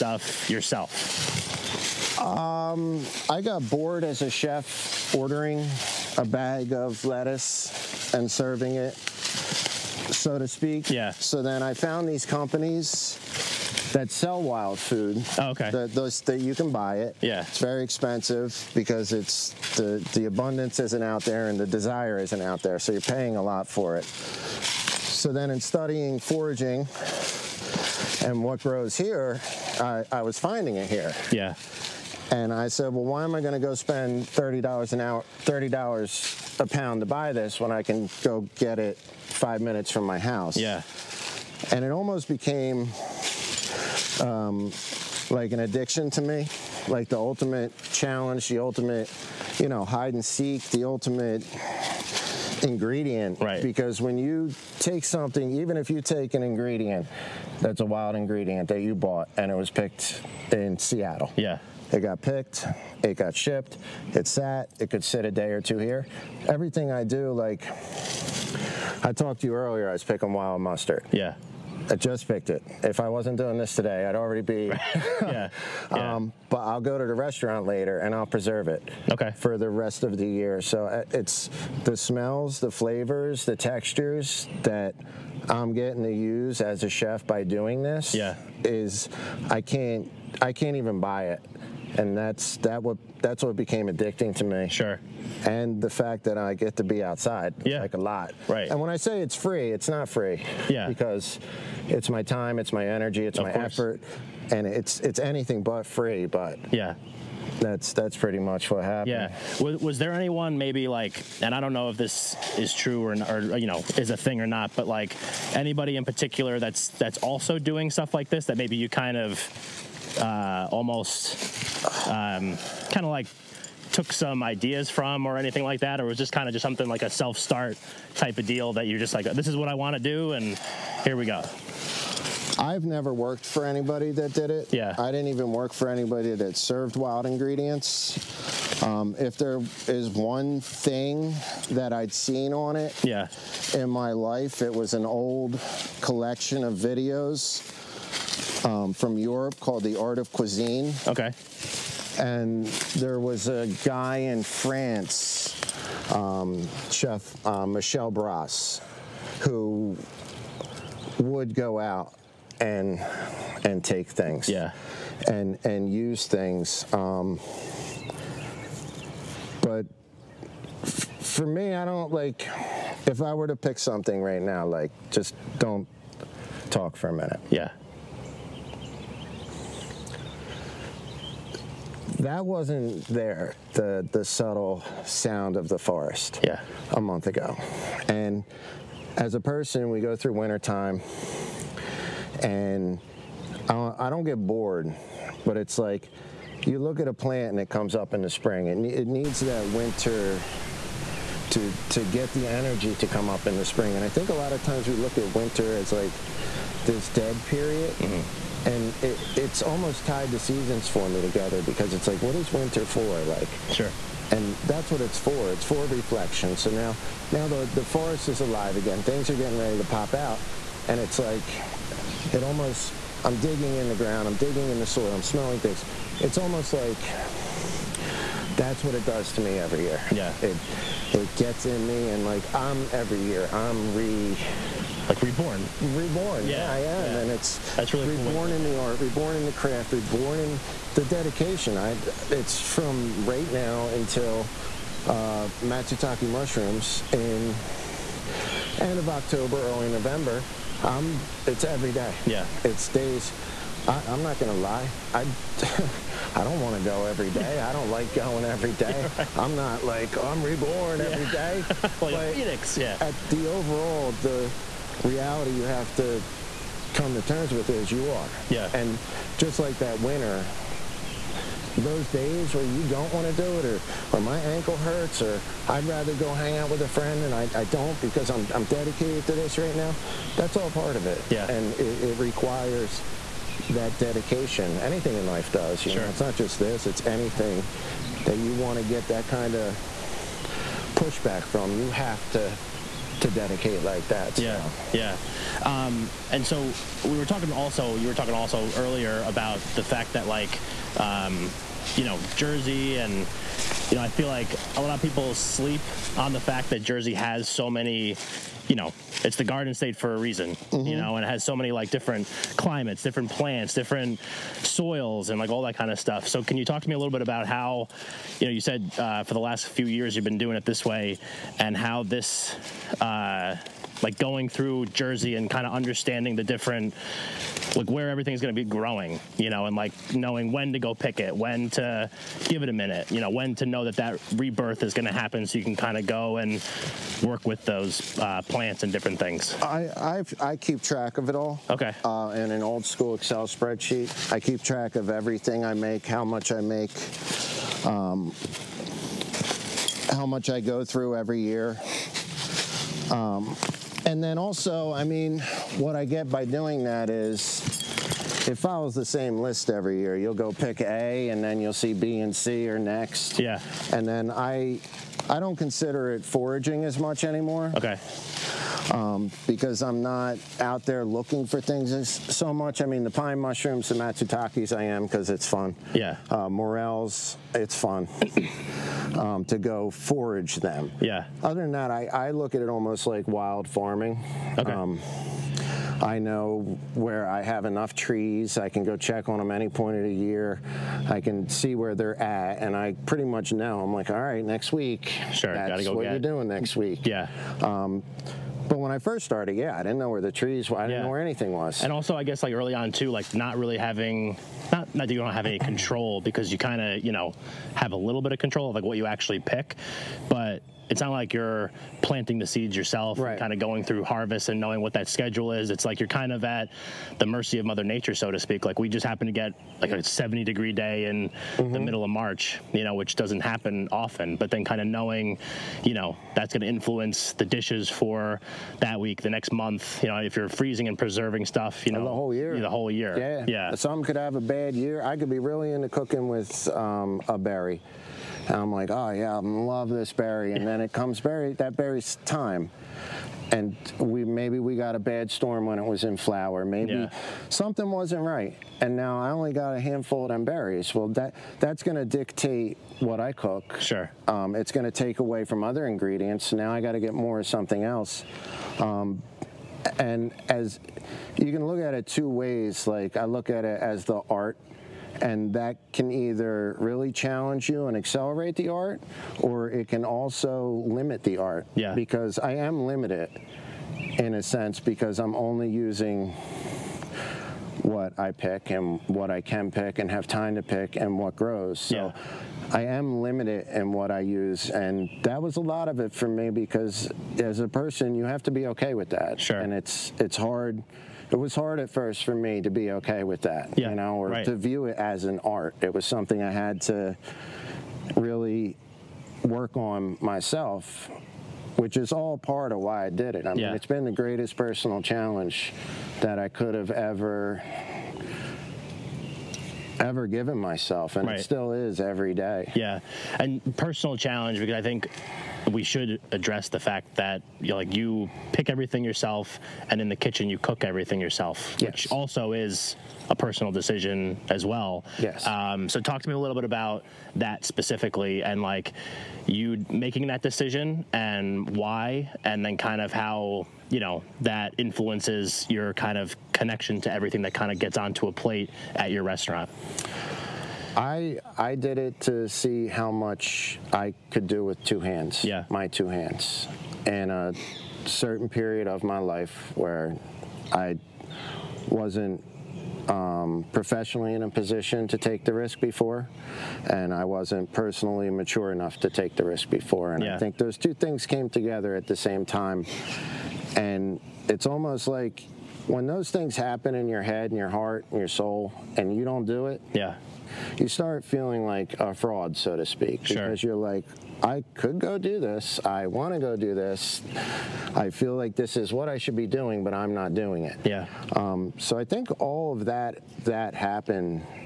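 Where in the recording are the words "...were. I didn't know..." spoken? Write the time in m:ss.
6:40.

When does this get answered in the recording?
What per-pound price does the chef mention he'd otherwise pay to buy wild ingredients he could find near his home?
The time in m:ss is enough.
0:35.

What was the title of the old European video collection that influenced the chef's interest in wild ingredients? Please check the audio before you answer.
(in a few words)
The Art of Cuisine.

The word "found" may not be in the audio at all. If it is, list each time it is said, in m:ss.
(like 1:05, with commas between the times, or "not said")
0:11.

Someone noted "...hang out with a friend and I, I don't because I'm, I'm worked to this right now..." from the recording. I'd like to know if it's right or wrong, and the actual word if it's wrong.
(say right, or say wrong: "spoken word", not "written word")
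wrong: "dedicated", not "worked".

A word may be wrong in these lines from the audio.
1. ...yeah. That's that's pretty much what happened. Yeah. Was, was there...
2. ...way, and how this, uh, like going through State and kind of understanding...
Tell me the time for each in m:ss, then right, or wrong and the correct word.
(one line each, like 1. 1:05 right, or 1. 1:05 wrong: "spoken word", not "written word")
1. 1:46 right
2. 5:20 wrong: "Jersey", not "State".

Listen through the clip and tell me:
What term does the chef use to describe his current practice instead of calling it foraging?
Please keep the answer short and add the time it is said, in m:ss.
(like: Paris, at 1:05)
wild farming, at 6:23.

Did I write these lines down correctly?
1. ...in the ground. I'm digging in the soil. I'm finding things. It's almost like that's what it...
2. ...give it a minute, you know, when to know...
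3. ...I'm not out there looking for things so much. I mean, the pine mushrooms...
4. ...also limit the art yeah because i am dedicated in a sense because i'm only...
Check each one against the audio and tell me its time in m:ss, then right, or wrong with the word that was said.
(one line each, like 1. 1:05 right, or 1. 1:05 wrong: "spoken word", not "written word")
1. 3:43 wrong: "smelling", not "finding"
2. 5:32 right
3. 6:09 right
4. 7:50 wrong: "limited", not "dedicated".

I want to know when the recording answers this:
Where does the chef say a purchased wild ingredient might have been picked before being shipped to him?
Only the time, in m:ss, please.
1:00.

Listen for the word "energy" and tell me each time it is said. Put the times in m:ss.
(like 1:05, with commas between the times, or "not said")
1:42, 3:22.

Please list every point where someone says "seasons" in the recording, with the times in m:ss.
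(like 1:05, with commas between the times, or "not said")
3:30.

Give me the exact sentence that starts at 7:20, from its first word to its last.
And then it comes berry, that berry's time.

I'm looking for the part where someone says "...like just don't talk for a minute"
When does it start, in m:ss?
2:54.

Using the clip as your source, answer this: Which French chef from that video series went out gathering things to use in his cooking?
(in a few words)
Michel Bras.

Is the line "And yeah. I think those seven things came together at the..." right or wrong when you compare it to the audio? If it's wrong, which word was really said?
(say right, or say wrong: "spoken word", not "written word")
wrong: "two", not "seven".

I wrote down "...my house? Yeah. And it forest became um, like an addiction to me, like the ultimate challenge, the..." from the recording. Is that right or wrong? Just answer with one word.
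wrong.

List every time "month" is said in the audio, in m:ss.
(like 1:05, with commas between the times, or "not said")
3:07, 7:09.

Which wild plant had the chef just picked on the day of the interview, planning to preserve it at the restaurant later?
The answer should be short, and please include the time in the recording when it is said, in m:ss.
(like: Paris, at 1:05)
wild mustard, at 1:10.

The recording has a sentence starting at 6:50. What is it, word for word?
But it's not like you're planting the seeds yourself right.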